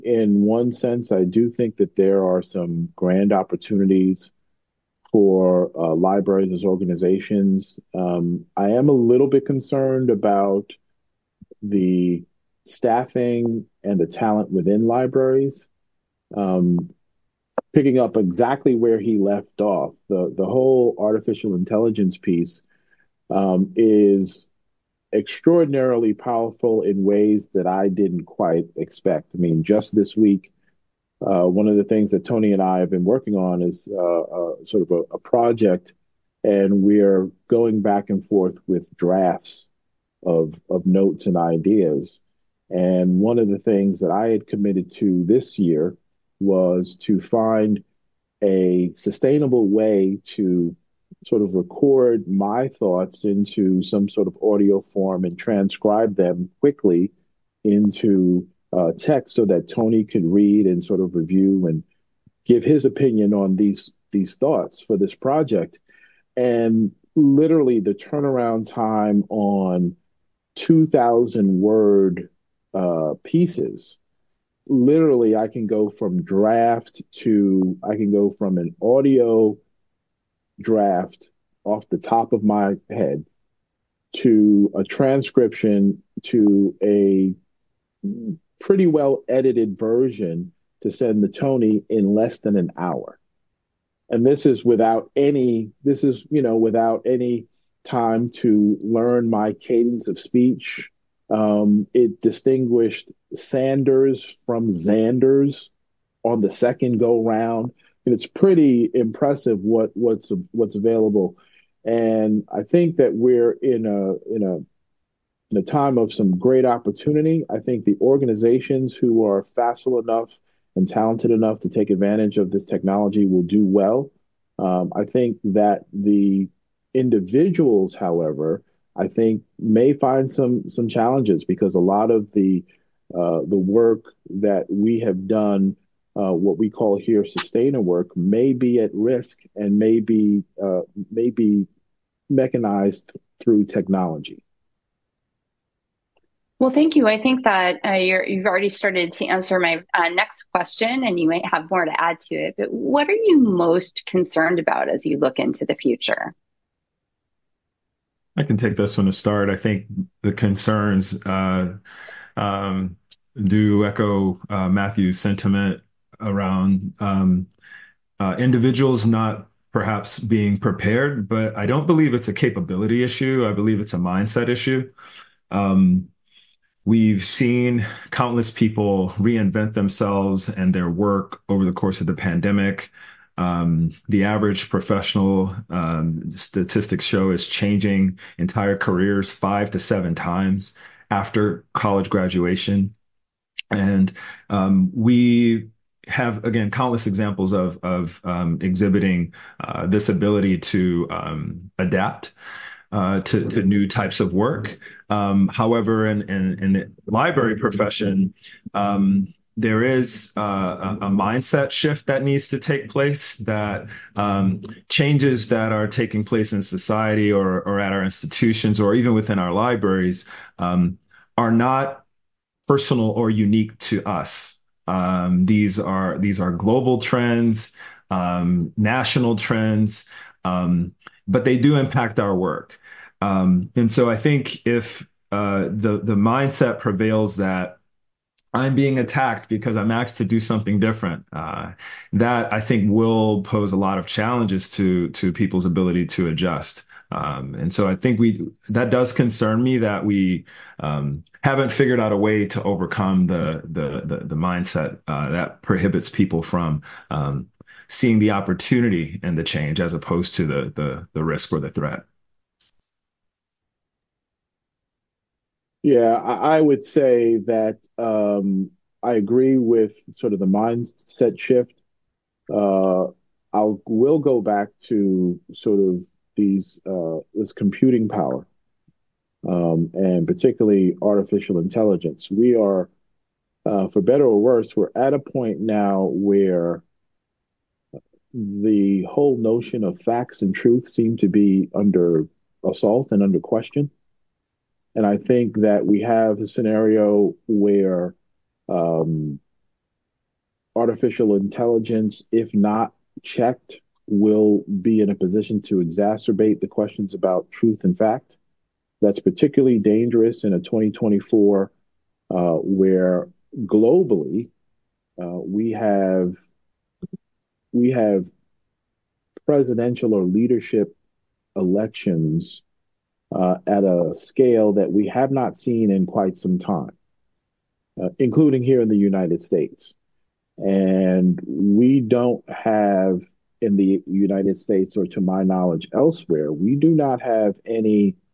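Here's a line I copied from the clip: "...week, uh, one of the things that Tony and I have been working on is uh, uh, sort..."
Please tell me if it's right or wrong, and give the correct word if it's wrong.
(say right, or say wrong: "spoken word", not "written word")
right.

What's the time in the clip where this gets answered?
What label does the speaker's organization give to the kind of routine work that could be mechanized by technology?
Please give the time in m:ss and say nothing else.
2:17.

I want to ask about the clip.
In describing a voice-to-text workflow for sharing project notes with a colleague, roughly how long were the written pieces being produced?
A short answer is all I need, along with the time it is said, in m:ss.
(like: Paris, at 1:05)
2000 words, at 1:10.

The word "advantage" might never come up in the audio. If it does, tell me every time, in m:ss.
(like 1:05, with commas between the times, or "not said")
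2:01.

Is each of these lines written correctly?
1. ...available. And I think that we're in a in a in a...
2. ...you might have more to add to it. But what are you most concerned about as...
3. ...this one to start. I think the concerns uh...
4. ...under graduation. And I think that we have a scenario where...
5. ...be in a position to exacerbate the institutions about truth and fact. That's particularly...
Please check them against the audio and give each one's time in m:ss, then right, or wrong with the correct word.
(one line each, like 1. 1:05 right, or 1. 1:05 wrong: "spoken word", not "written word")
1. 1:50 right
2. 2:31 right
3. 2:38 right
4. 4:53 wrong: "question", not "graduation"
5. 5:04 wrong: "questions", not "institutions".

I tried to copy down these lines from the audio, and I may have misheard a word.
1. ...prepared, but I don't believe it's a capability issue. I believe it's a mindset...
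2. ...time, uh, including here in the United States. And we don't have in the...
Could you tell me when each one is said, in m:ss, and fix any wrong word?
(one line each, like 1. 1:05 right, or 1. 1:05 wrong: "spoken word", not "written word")
1. 2:50 right
2. 5:26 right.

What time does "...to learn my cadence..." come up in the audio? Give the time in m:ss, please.
1:38.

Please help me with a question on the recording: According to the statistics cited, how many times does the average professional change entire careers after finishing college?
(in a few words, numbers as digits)
5 to 7.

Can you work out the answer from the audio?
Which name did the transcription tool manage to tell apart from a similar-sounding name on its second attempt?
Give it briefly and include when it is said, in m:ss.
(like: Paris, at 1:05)
Sanders, at 1:43.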